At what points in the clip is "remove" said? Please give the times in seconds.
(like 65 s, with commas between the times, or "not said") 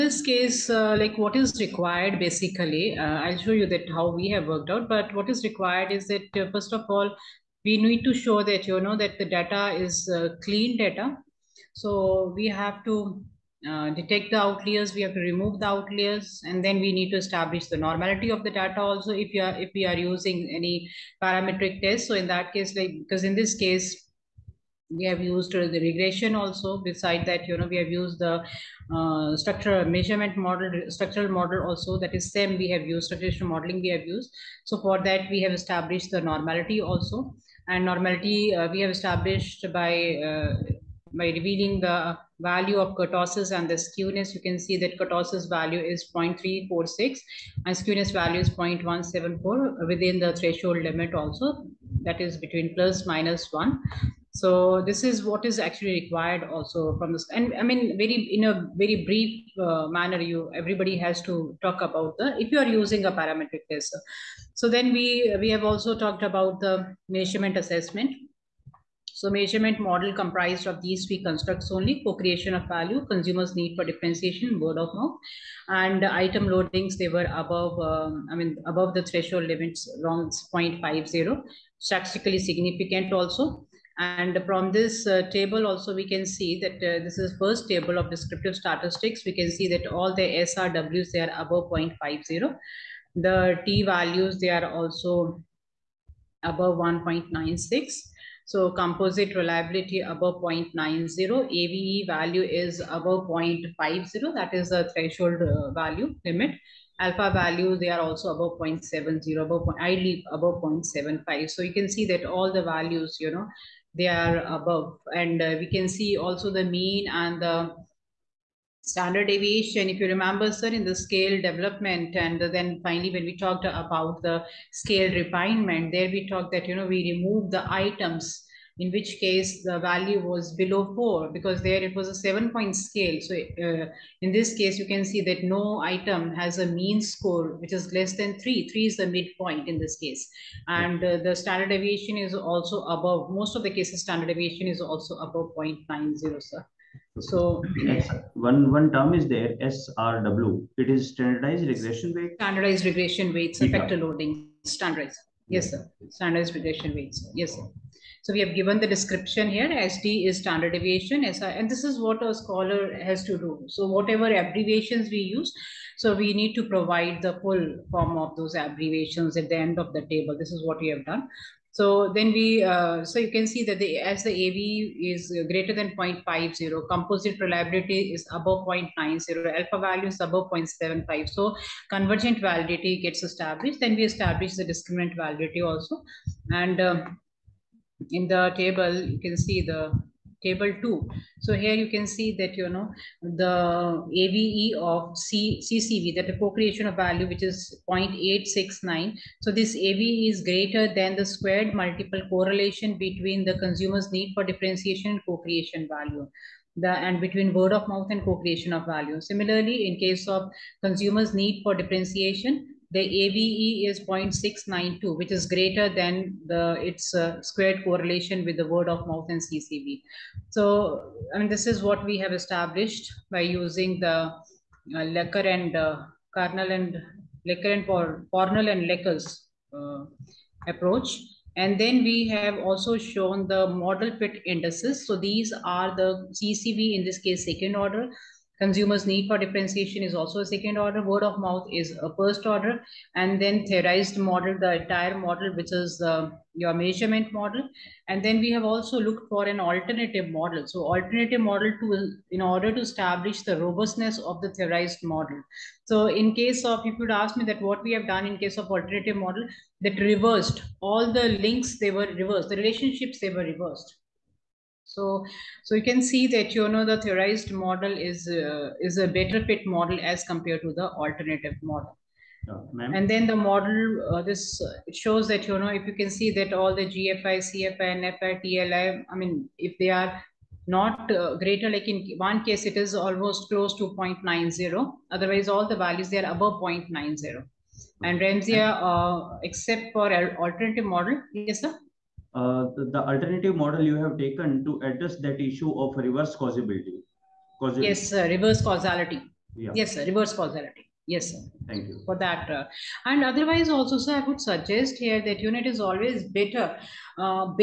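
15 s, 127 s.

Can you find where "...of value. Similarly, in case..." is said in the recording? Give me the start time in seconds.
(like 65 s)
208 s.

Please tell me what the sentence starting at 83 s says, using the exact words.
And from this uh, table also, we can see that uh, this is first table of descriptive statistics.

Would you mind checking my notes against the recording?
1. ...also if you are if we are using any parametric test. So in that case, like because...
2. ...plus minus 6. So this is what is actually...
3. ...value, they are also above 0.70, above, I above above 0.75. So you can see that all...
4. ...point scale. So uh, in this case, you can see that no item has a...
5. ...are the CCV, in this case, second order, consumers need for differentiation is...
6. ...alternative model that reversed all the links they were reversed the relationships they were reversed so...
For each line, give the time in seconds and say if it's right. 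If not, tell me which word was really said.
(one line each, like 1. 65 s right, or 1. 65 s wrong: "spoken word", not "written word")
1. 18 s right
2. 52 s wrong: "1", not "6"
3. 107 s wrong: "leave", not "above"
4. 132 s right
5. 235 s right
6. 258 s right.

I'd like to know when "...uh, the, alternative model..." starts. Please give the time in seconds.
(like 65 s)
292 s.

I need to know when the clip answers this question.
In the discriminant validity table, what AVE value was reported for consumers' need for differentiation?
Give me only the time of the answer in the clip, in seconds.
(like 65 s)
214 s.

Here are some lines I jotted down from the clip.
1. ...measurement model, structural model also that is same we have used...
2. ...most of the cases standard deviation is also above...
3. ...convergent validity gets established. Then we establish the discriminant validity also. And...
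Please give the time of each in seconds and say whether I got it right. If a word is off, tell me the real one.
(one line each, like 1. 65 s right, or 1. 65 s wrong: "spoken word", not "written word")
1. 29 s right
2. 143 s right
3. 181 s right.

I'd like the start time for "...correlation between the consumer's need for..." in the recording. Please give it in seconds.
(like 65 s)
202 s.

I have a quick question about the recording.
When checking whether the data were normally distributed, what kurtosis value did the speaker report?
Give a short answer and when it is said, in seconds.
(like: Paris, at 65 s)
0.346, at 46 s.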